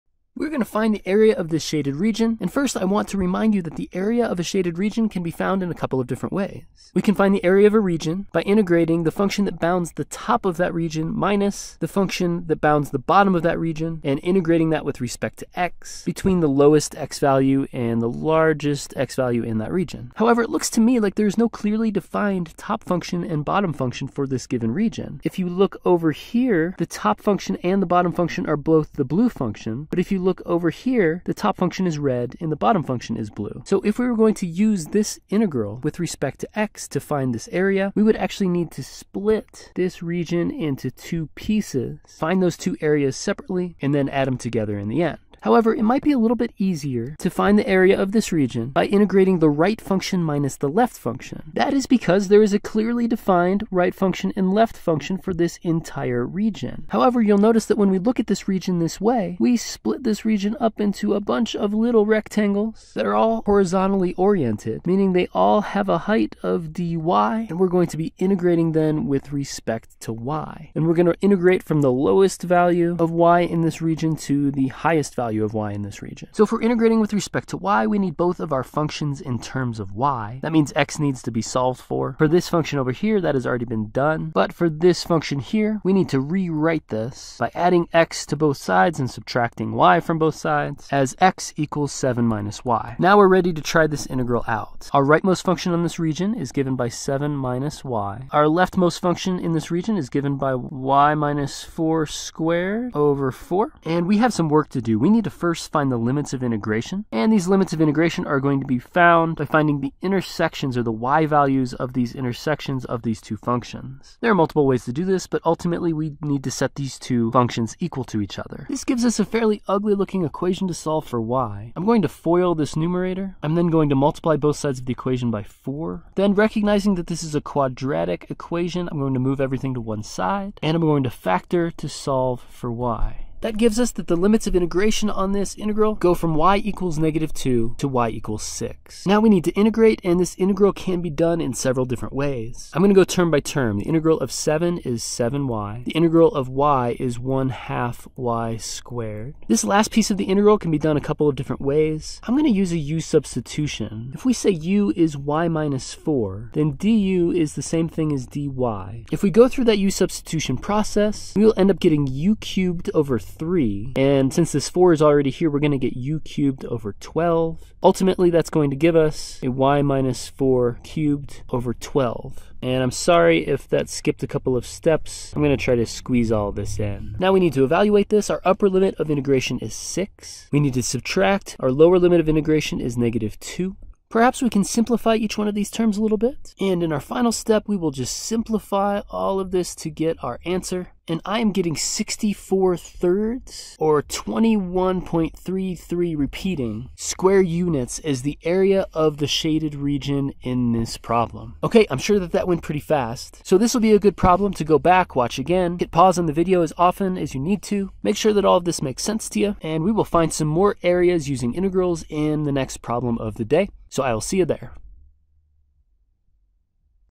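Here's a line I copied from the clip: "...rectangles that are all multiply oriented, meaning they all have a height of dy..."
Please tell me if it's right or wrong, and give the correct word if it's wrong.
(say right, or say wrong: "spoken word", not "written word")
wrong: "horizontally", not "multiply".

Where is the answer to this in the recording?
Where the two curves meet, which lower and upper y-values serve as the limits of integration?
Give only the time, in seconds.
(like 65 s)
136 s.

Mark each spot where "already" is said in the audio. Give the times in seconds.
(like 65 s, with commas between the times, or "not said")
83 s, 165 s.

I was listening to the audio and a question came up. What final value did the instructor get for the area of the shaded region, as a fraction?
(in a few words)
64/3.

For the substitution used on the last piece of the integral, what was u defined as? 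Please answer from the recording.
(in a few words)
y - 4.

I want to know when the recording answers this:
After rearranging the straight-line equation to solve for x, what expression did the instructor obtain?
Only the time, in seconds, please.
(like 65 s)
91 s.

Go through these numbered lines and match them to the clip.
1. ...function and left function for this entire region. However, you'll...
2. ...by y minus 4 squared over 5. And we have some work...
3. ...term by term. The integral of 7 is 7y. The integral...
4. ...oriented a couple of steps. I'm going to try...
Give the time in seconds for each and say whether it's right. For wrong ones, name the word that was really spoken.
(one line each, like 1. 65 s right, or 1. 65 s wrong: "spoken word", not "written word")
1. 53 s right
2. 100 s wrong: "4", not "5"
3. 143 s right
4. 173 s wrong: "skipped", not "oriented".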